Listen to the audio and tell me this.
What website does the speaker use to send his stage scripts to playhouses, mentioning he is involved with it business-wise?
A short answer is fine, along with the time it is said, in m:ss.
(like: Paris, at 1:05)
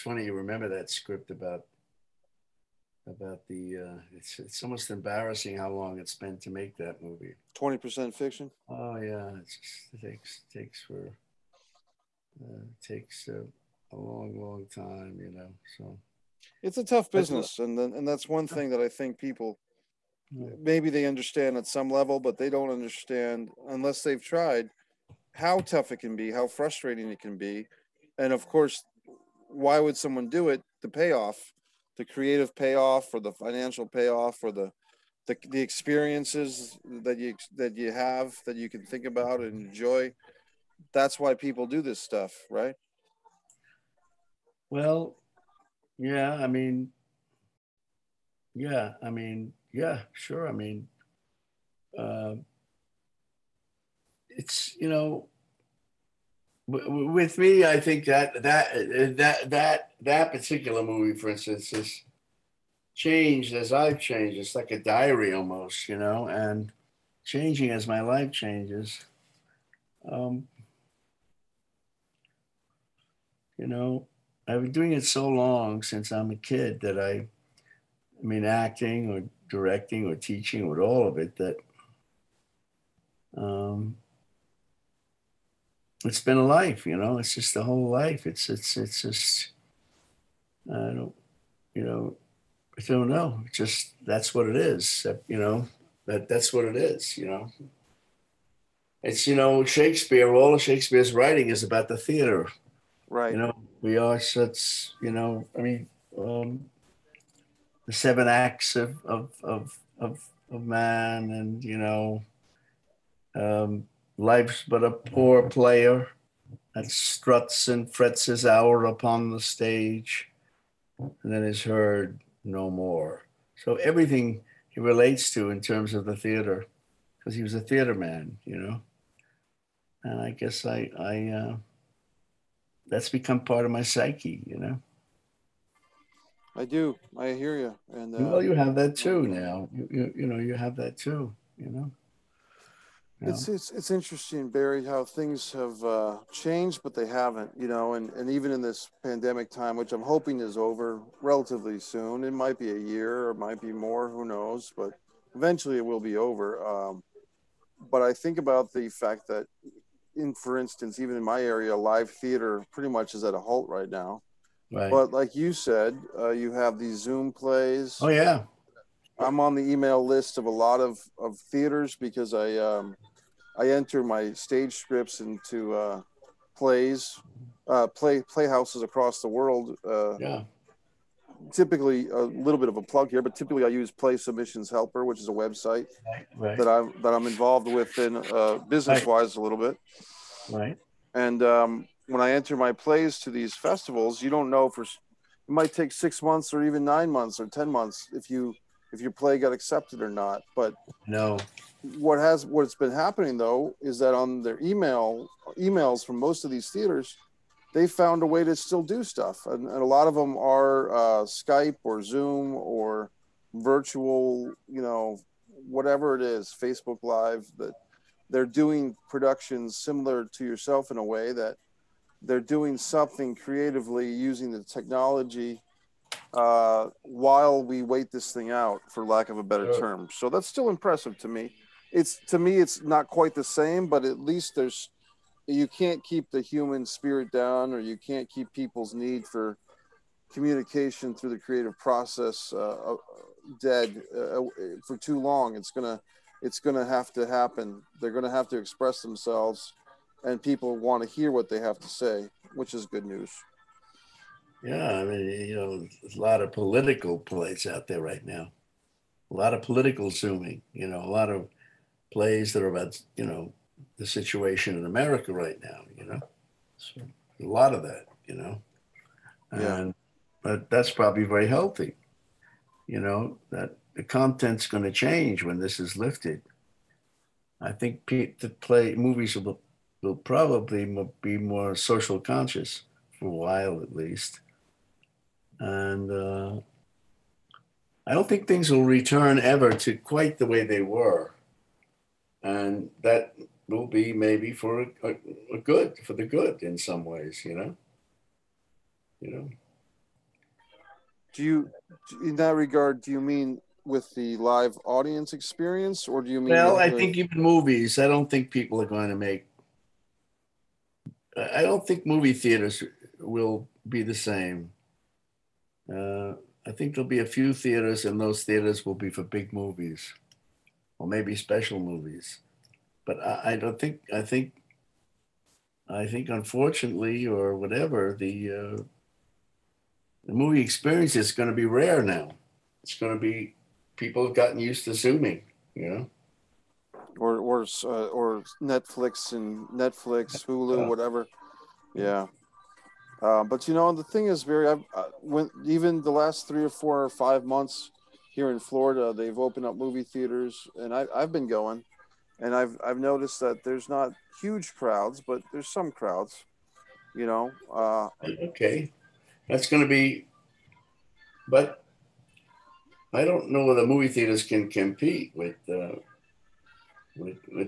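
Play Submissions Helper, at 3:03.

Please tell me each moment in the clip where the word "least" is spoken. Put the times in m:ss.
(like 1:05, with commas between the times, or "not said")
3:54, 4:43.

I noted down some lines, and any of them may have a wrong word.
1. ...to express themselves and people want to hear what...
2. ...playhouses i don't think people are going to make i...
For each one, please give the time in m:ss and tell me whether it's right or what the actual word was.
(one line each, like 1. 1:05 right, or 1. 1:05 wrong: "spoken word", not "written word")
1. 4:08 right
2. 5:07 wrong: "movies", not "playhouses".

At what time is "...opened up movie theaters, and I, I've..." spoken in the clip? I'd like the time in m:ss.
5:49.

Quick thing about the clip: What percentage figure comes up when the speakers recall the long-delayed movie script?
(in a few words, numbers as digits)
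20 percent.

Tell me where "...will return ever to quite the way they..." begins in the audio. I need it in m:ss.
4:48.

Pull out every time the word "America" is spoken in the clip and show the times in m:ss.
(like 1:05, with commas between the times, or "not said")
4:24.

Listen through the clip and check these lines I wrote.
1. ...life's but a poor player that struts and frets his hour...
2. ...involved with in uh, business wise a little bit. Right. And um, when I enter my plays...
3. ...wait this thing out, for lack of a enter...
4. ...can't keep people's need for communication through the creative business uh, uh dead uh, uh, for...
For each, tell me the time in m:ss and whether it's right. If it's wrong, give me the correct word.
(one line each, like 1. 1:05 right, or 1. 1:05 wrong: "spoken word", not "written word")
1. 1:54 right
2. 3:07 right
3. 3:47 wrong: "better", not "enter"
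4. 3:57 wrong: "process", not "business".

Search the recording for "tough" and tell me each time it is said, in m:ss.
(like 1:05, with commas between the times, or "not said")
0:16, 0:25.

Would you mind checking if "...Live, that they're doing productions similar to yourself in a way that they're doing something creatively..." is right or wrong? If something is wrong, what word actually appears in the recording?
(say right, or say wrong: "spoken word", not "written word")
right.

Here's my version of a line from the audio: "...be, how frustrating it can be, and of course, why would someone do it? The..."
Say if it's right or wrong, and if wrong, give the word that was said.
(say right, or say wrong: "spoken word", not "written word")
right.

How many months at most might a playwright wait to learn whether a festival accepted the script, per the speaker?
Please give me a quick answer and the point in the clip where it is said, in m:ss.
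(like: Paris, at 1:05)
10 months, at 3:17.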